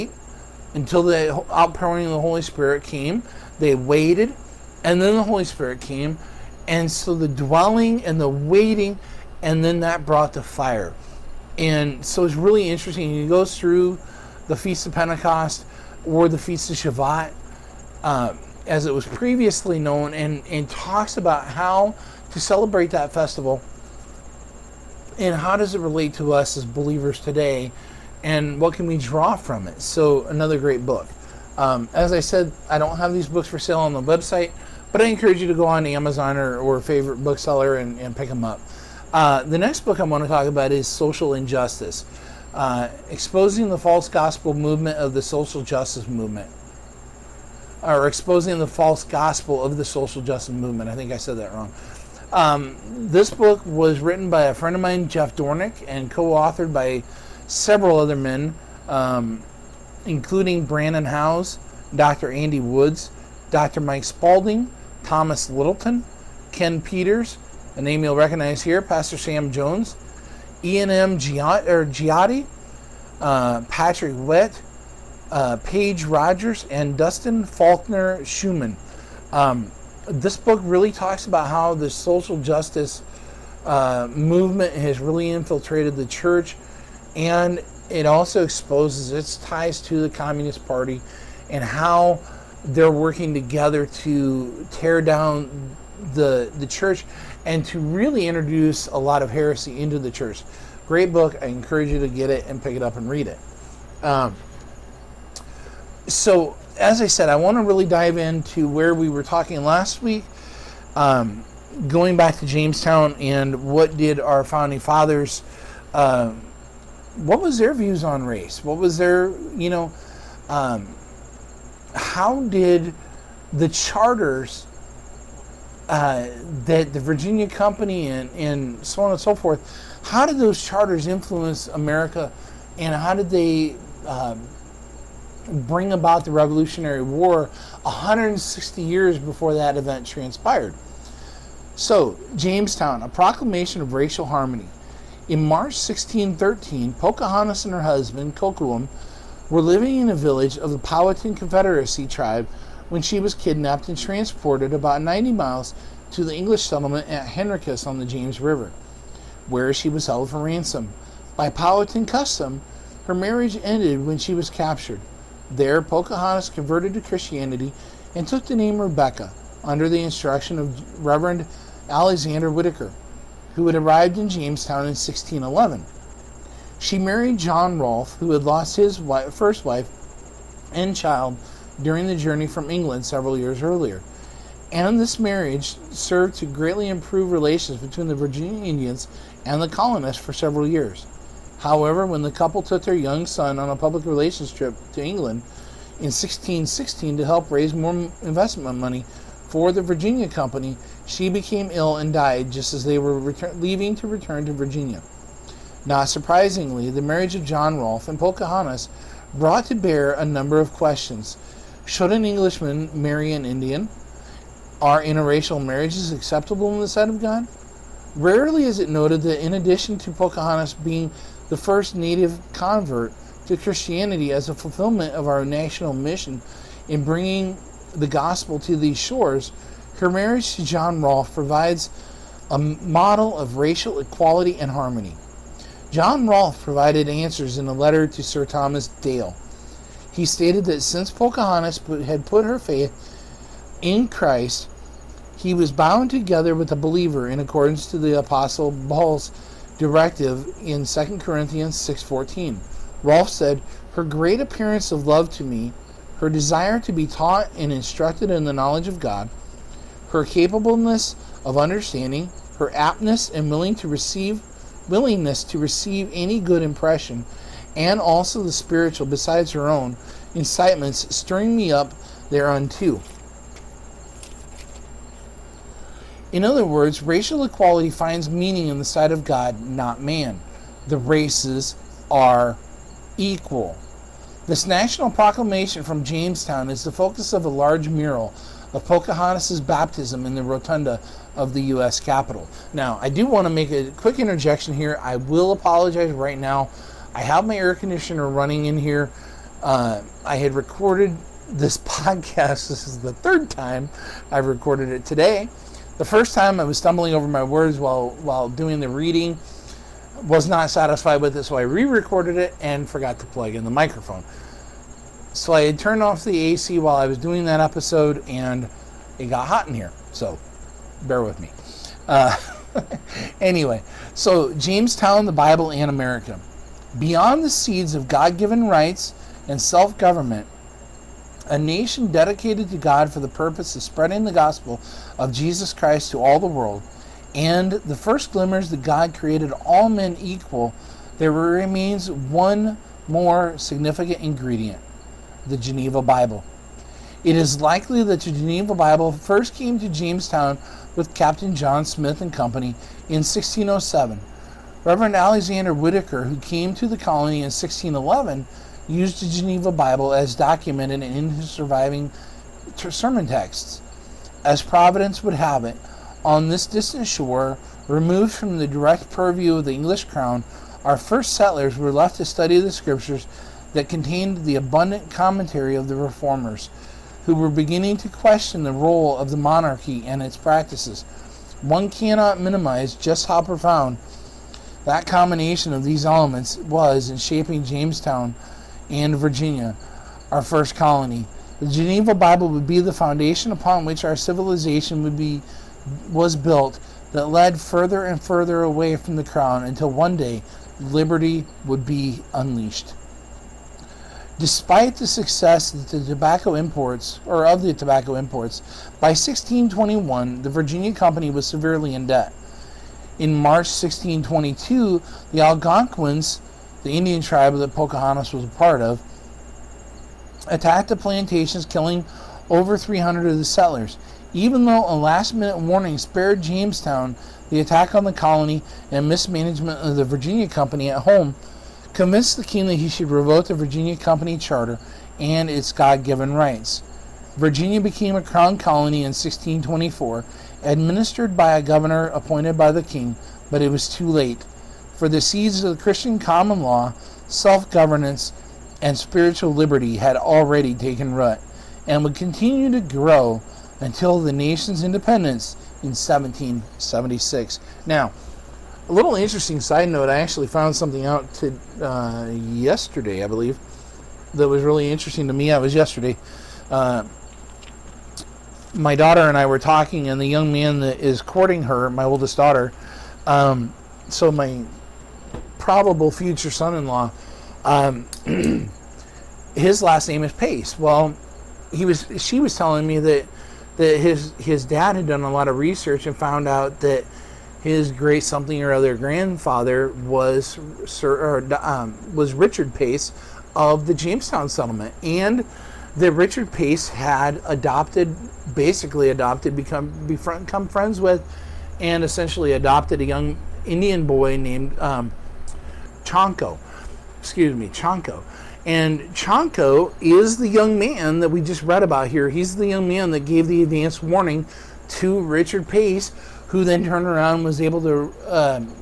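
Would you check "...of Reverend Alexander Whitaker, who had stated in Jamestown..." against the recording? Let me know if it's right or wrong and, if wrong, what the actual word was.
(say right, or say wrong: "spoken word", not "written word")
wrong: "arrived", not "stated".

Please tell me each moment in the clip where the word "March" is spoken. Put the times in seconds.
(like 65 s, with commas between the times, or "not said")
145 s, 413 s.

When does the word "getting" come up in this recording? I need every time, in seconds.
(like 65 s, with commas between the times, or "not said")
not said.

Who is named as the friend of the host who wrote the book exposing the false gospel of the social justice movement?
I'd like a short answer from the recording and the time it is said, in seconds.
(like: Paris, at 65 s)
Jeff Dornik, at 55 s.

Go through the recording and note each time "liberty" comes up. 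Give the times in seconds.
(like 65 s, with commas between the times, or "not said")
400 s, 449 s.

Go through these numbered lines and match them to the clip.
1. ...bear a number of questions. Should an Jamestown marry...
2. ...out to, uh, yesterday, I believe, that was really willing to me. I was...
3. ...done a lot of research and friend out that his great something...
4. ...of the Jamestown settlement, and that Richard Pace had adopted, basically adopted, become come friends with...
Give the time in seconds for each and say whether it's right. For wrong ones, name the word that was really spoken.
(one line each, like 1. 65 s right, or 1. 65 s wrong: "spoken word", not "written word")
1. 209 s wrong: "Englishman", not "Jamestown"
2. 461 s wrong: "interesting", not "willing"
3. 485 s wrong: "found", not "friend"
4. 493 s right.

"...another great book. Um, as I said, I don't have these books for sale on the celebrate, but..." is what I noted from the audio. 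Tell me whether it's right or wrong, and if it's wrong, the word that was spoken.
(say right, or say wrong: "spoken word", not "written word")
wrong: "website", not "celebrate".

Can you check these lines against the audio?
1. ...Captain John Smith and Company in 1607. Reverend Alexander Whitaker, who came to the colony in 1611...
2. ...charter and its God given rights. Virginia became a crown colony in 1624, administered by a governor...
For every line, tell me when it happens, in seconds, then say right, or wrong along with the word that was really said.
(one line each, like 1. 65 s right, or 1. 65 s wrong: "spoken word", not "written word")
1. 351 s right
2. 434 s right.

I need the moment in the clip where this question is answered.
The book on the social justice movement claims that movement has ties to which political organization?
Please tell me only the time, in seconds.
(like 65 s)
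90 s.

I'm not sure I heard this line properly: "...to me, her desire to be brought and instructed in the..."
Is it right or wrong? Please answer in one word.
wrong.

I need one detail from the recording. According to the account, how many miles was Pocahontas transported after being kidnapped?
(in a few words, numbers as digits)
90 miles.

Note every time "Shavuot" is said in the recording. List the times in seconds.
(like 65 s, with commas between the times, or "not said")
16 s.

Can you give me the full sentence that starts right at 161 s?
By Powhatan custom, her marriage ended when she was captured.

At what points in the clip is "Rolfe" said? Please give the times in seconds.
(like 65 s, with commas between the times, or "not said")
177 s, 207 s, 231 s, 236 s, 253 s.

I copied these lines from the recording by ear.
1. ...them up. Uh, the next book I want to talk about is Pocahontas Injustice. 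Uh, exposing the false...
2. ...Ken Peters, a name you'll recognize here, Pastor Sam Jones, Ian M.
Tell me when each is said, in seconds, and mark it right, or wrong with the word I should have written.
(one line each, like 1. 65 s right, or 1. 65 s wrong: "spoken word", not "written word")
1. 38 s wrong: "Social", not "Pocahontas"
2. 66 s right.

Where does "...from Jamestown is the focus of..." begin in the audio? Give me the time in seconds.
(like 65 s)
285 s.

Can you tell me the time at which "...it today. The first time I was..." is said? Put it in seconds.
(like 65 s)
304 s.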